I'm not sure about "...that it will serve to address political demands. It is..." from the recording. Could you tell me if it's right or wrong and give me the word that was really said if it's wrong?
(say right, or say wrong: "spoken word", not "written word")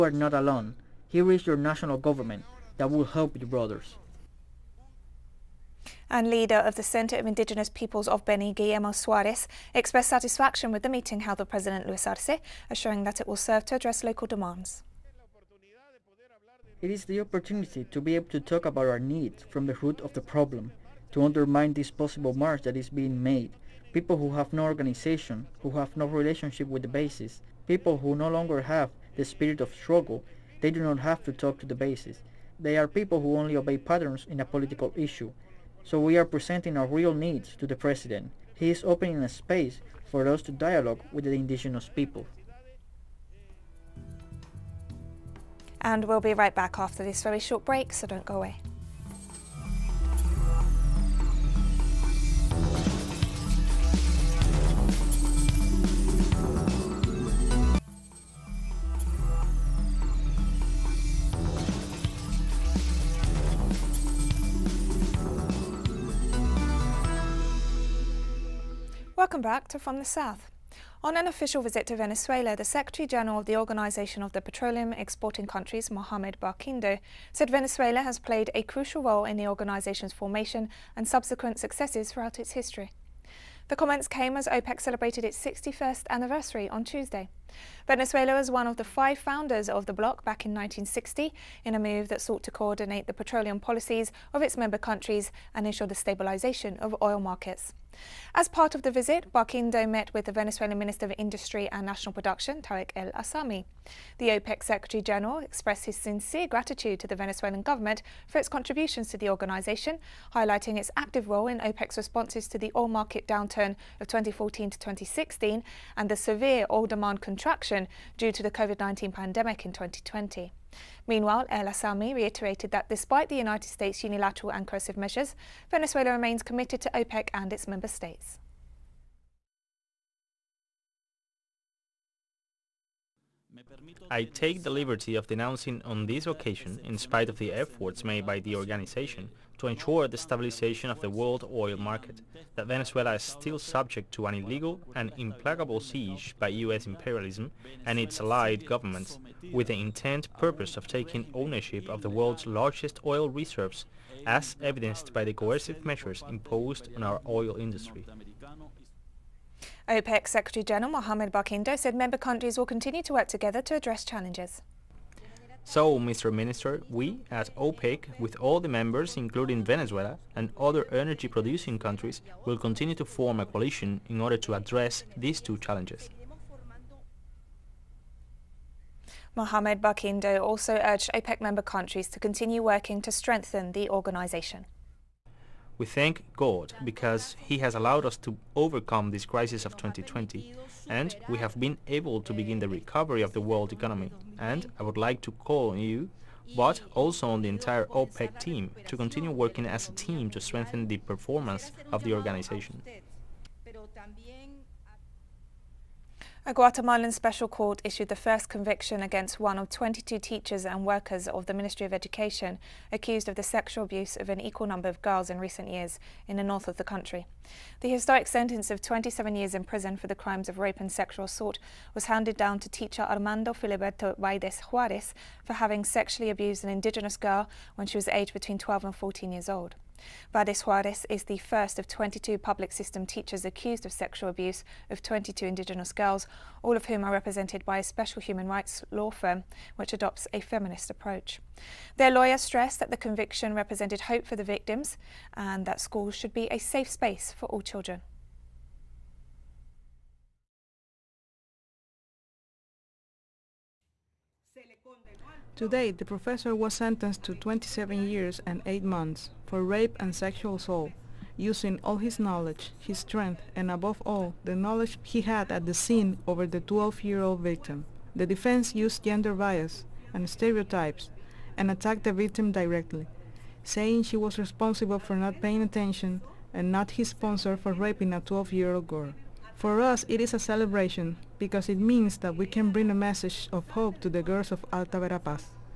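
wrong: "local", not "political".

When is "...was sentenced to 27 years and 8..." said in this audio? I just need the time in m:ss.
4:16.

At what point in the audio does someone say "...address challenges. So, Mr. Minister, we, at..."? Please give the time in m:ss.
2:43.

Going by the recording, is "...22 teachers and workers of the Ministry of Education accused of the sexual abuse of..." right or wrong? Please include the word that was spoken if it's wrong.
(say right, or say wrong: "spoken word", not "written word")
right.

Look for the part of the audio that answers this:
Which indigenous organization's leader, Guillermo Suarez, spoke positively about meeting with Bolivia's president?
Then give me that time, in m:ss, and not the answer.
0:06.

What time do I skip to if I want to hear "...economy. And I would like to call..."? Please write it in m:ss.
3:13.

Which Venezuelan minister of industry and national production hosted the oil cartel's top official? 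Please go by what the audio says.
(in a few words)
Tarek El Aissami.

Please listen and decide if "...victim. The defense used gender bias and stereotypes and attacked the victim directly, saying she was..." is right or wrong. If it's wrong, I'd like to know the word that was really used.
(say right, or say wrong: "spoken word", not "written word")
right.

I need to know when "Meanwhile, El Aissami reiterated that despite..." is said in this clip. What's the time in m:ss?
2:01.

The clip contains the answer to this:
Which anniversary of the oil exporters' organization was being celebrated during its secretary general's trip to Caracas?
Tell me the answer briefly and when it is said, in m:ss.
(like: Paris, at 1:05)
61st, at 1:25.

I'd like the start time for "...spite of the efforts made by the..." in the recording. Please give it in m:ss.
2:16.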